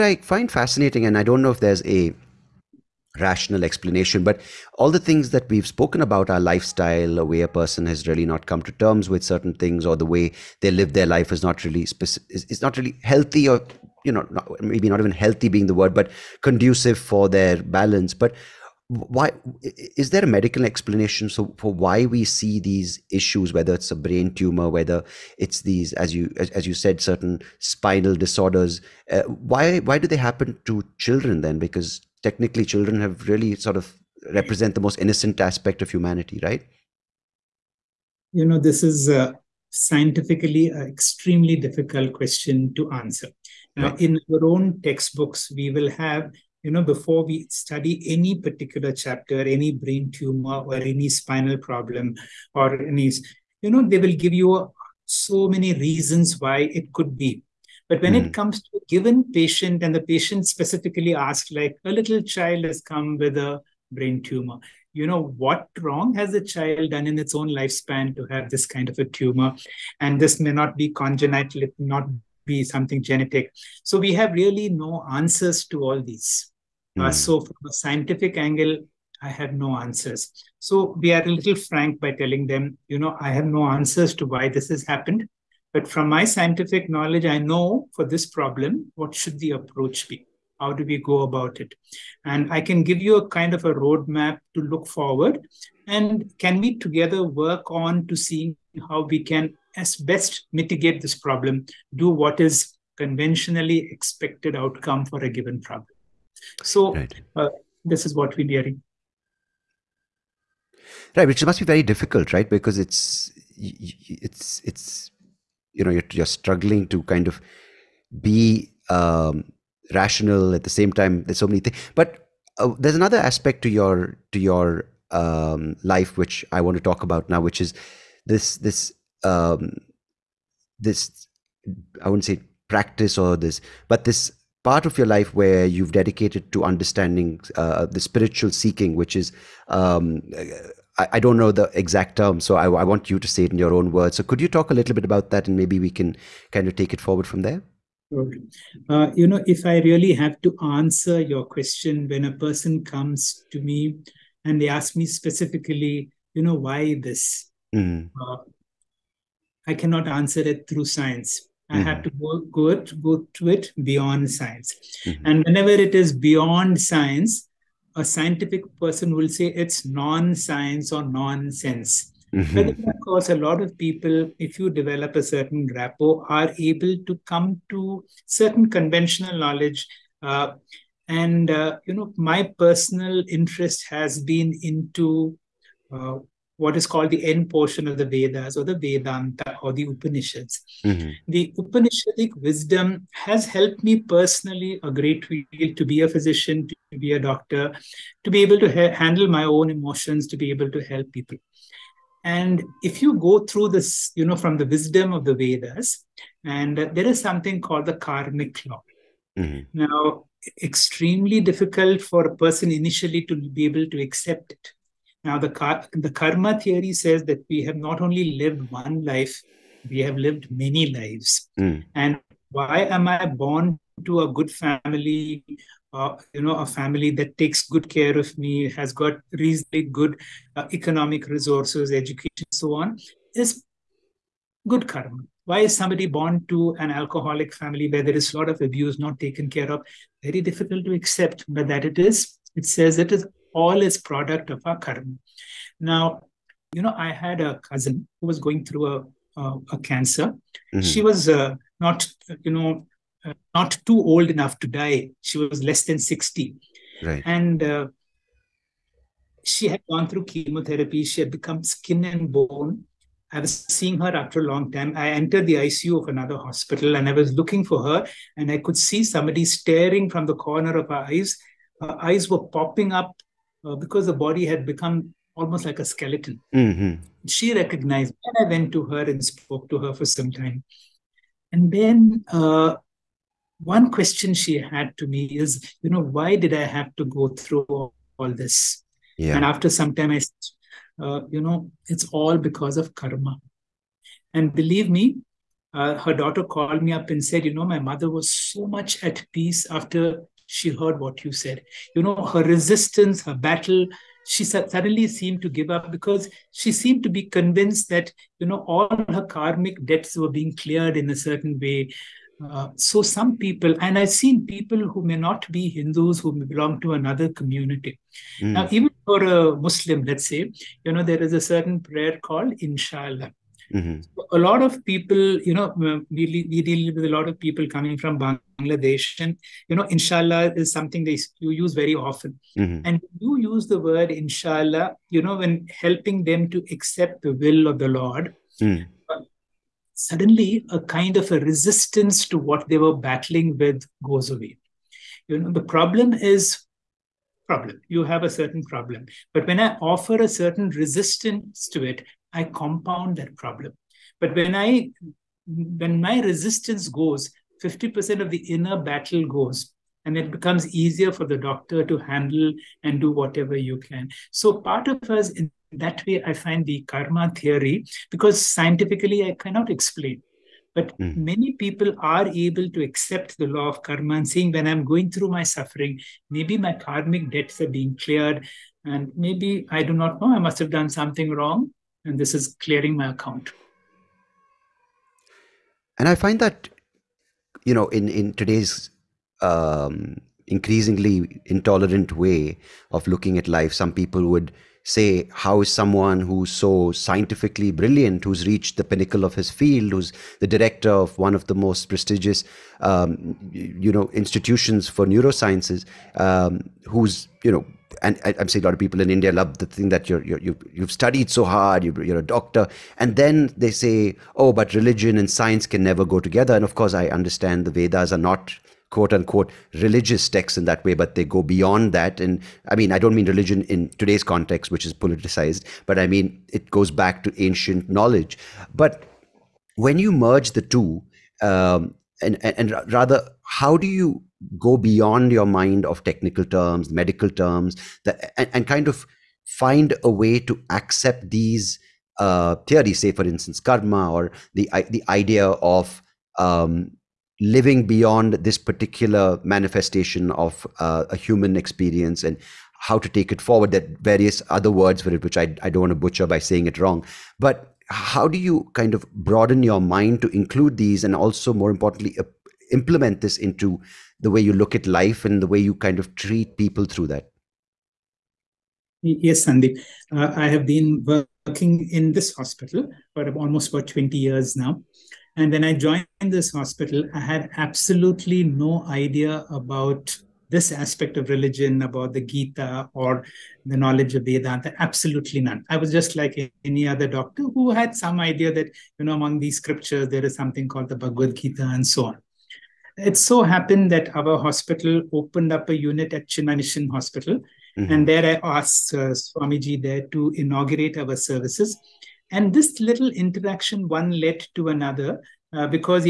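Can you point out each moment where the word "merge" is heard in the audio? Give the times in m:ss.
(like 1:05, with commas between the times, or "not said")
7:10.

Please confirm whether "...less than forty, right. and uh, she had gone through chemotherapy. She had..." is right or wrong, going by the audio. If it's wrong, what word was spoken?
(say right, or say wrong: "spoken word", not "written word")
wrong: "sixty", not "forty".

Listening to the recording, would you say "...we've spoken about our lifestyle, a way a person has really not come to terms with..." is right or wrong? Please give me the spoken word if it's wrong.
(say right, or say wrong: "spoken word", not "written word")
right.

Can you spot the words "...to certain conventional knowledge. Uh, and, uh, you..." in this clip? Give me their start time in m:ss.
2:57.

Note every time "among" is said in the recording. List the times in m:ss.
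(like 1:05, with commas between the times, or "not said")
8:09.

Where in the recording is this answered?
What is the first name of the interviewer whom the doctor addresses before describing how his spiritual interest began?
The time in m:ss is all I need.
7:49.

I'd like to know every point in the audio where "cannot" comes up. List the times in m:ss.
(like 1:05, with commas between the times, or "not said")
2:39, 6:09.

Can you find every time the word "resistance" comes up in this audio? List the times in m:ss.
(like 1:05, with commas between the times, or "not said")
5:02, 5:41, 5:50, 5:56.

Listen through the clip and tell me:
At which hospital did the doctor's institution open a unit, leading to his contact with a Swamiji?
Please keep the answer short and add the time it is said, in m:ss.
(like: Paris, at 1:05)
Chinmaya Mission Hospital, at 8:16.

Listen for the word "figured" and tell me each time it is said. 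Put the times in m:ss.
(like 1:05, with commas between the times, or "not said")
not said.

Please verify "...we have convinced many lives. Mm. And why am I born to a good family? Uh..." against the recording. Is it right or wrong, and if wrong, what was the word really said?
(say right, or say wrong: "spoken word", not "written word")
wrong: "lived", not "convinced".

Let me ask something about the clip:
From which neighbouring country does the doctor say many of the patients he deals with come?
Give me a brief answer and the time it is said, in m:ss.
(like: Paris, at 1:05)
Bangladesh, at 5:28.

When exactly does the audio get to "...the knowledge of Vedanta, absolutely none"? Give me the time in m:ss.
8:03.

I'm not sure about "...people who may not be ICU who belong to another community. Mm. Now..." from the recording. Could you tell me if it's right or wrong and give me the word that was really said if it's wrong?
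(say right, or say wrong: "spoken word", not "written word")
wrong: "Hindus", not "ICU".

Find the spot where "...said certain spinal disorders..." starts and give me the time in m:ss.
0:26.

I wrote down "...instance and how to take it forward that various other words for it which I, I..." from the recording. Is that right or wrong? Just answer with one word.
wrong.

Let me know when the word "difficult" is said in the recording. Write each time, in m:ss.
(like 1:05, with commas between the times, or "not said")
0:41, 1:51, 3:31, 4:00.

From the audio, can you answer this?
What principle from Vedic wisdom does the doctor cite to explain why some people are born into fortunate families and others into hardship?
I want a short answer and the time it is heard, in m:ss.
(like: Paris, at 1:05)
karmic law, at 3:27.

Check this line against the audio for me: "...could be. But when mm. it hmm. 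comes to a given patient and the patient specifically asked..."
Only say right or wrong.
right.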